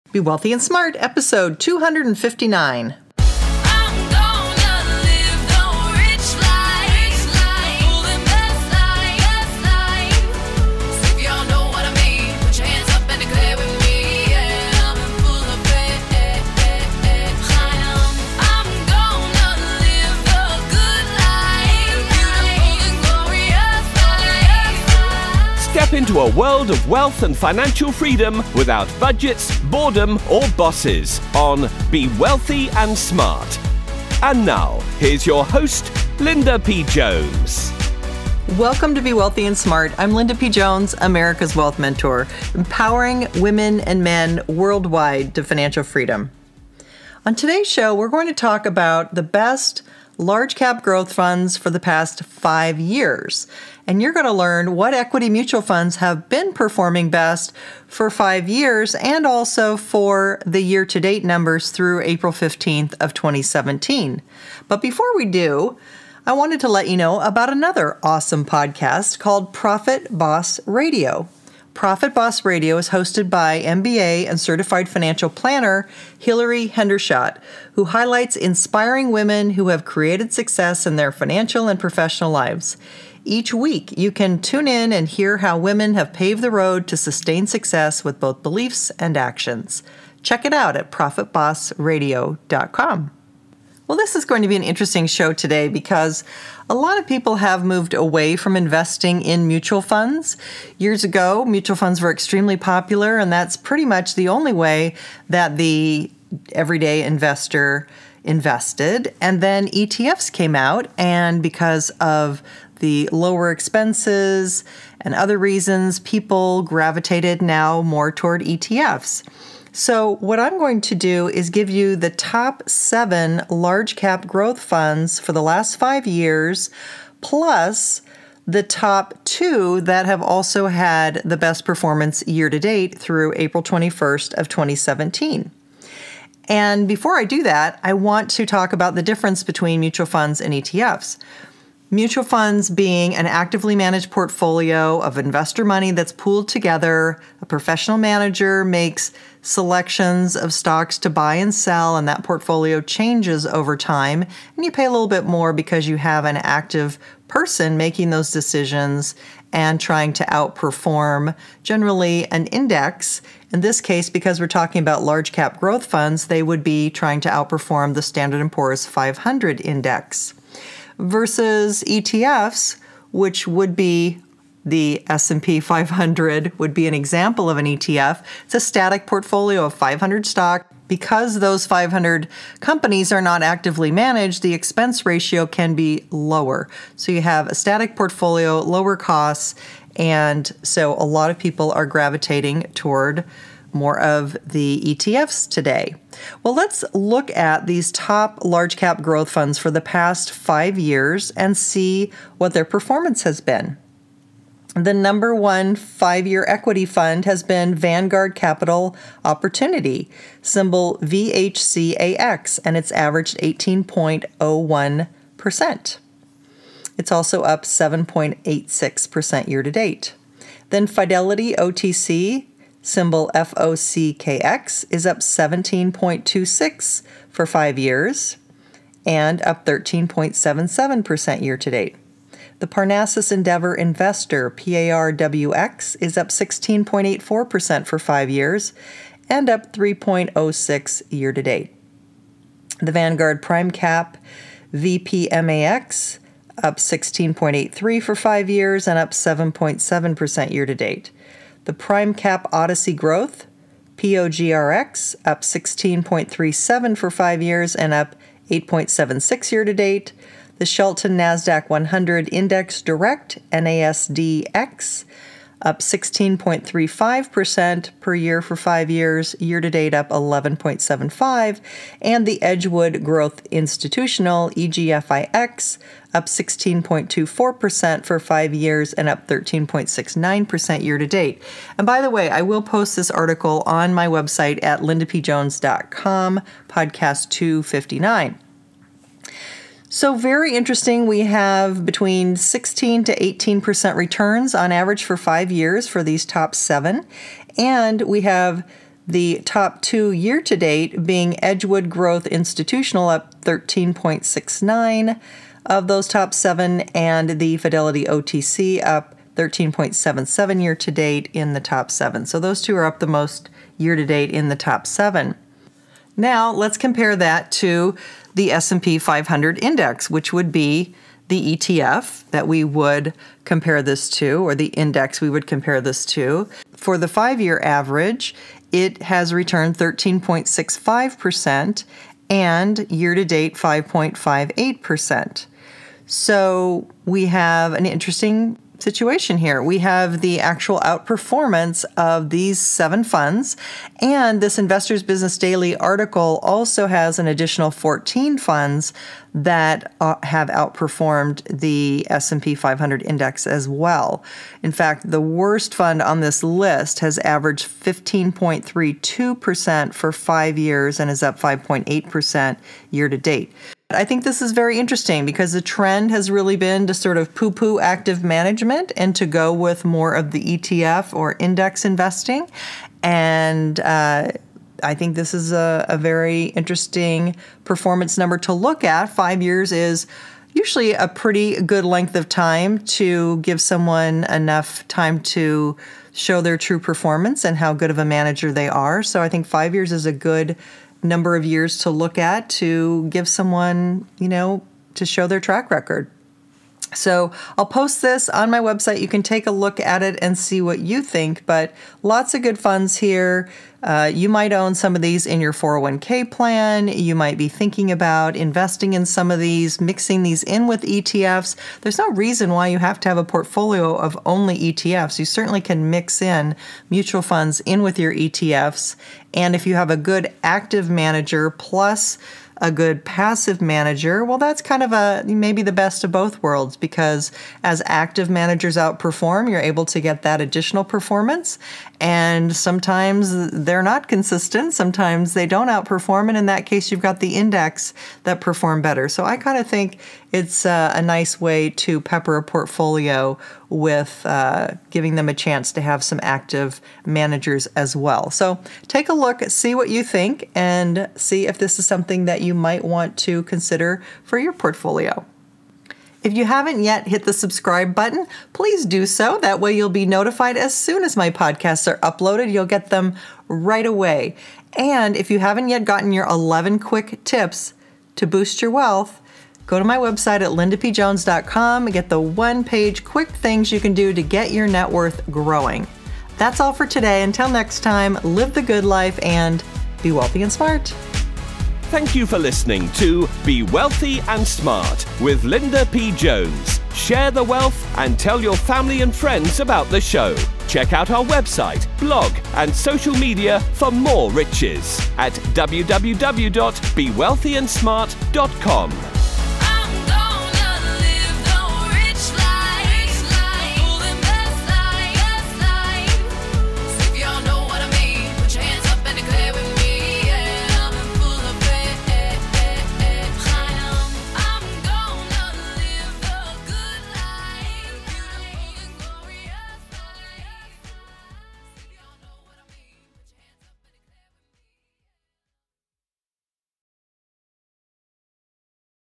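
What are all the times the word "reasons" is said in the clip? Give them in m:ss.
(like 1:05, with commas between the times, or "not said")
1:55, 6:52.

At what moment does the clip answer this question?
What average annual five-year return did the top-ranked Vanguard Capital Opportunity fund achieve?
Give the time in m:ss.
3:33.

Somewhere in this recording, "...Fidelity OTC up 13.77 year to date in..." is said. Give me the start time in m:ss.
5:07.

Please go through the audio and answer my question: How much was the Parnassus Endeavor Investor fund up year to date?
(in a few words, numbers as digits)
3.06%.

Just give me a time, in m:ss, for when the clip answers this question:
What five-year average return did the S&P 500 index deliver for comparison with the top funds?
5:29.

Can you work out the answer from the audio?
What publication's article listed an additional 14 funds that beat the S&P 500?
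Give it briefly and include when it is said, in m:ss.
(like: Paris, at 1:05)
Investors Business Daily, at 5:44.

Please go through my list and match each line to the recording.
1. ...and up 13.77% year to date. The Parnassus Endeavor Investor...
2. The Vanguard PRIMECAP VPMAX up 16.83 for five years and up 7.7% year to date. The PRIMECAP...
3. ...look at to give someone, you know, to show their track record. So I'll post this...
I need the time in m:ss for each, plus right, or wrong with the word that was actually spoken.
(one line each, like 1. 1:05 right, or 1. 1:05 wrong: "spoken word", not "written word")
1. 3:49 right
2. 4:02 right
3. 6:31 right.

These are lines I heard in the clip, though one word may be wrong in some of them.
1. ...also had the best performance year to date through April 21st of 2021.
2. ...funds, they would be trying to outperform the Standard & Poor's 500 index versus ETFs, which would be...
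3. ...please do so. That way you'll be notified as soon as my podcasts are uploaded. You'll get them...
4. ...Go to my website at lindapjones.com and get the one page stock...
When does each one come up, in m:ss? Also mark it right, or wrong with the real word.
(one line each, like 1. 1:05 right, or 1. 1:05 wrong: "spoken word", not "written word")
1. 2:10 wrong: "2017", not "2021"
2. 2:45 right
3. 7:38 right
4. 7:49 wrong: "quick", not "stock".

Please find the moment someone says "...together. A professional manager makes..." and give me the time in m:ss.
2:26.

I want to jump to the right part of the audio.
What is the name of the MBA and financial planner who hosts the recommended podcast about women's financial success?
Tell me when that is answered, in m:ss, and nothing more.
1:16.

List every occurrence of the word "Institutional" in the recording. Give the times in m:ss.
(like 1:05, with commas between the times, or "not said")
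4:33, 5:02.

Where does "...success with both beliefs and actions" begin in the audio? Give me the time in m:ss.
1:27.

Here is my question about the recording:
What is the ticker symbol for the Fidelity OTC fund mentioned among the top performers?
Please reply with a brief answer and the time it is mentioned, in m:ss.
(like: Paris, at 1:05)
FOCKX, at 3:43.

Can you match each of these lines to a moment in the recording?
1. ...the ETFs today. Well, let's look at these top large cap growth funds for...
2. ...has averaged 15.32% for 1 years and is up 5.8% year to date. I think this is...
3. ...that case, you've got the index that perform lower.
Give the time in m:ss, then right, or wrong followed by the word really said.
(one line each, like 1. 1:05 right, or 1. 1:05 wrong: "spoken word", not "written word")
1. 3:14 right
2. 5:56 wrong: "5", not "1"
3. 7:16 wrong: "better", not "lower".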